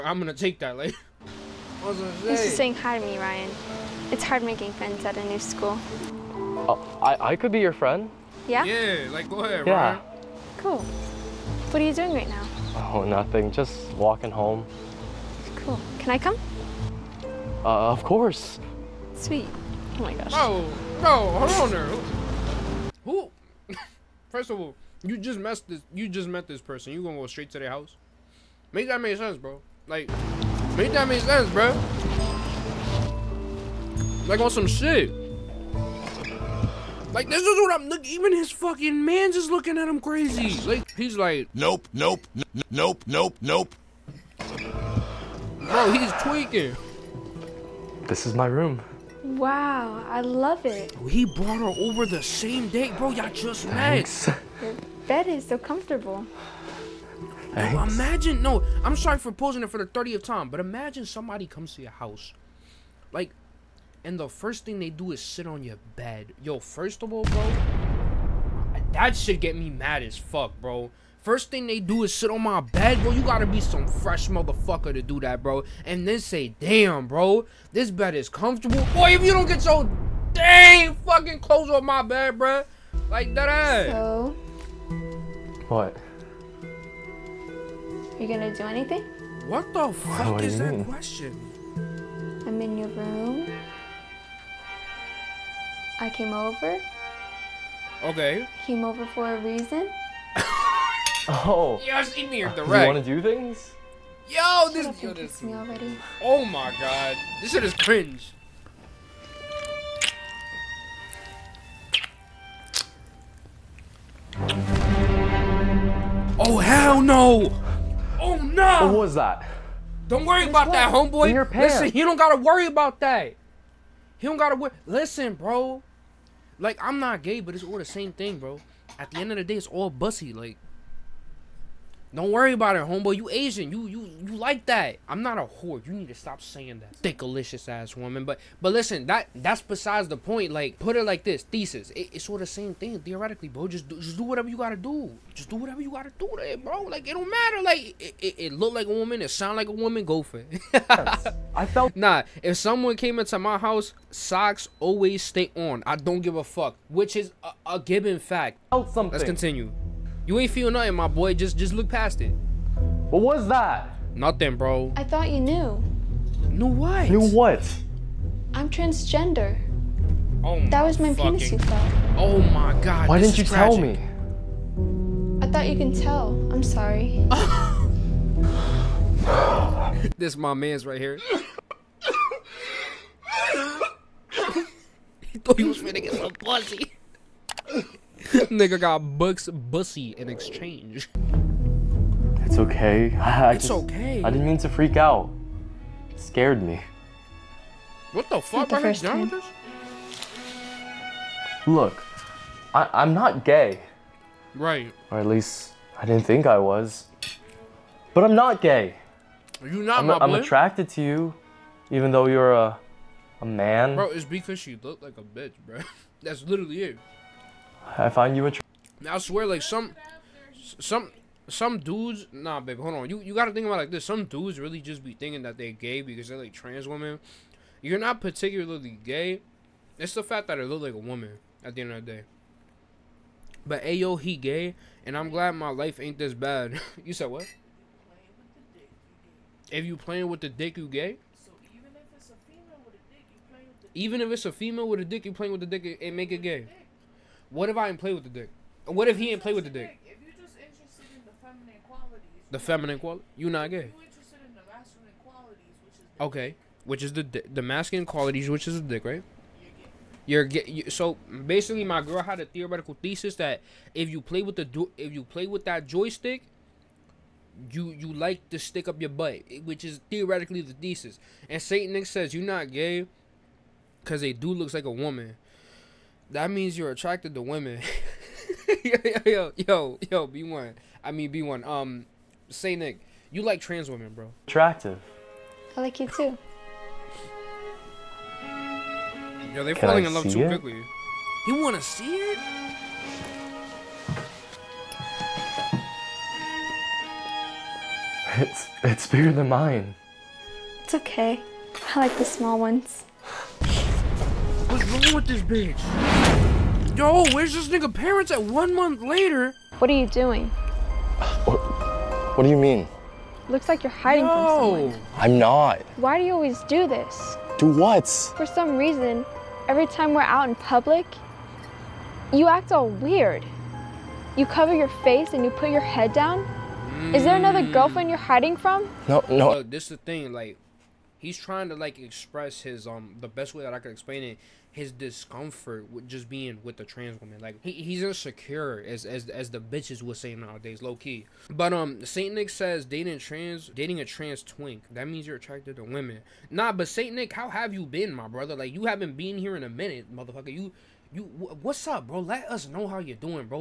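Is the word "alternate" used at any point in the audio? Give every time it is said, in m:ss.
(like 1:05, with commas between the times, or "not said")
not said.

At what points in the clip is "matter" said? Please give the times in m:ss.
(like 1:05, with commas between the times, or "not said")
2:27.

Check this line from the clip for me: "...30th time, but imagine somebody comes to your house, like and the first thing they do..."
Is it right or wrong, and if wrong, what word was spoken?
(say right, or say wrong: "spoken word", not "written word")
right.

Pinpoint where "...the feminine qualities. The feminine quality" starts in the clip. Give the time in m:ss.
4:11.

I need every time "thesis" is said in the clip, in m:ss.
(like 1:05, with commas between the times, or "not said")
2:21, 4:23, 4:30.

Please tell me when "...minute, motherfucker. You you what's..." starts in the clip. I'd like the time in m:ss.
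5:49.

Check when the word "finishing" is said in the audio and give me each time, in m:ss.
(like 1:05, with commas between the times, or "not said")
not said.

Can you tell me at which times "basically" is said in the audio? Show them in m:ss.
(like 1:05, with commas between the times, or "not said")
4:21.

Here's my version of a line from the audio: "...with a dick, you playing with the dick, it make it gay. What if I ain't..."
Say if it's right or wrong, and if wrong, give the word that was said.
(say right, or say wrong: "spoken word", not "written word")
right.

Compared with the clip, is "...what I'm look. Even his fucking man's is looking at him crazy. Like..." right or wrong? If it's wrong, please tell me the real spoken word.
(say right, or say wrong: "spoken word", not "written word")
right.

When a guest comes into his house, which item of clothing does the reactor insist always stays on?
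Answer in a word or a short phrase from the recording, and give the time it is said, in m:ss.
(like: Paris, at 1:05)
Socks, at 2:34.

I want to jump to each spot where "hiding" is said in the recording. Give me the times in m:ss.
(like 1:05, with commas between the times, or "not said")
5:13, 5:28.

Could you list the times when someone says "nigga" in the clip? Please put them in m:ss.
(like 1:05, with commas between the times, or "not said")
3:08, 5:07.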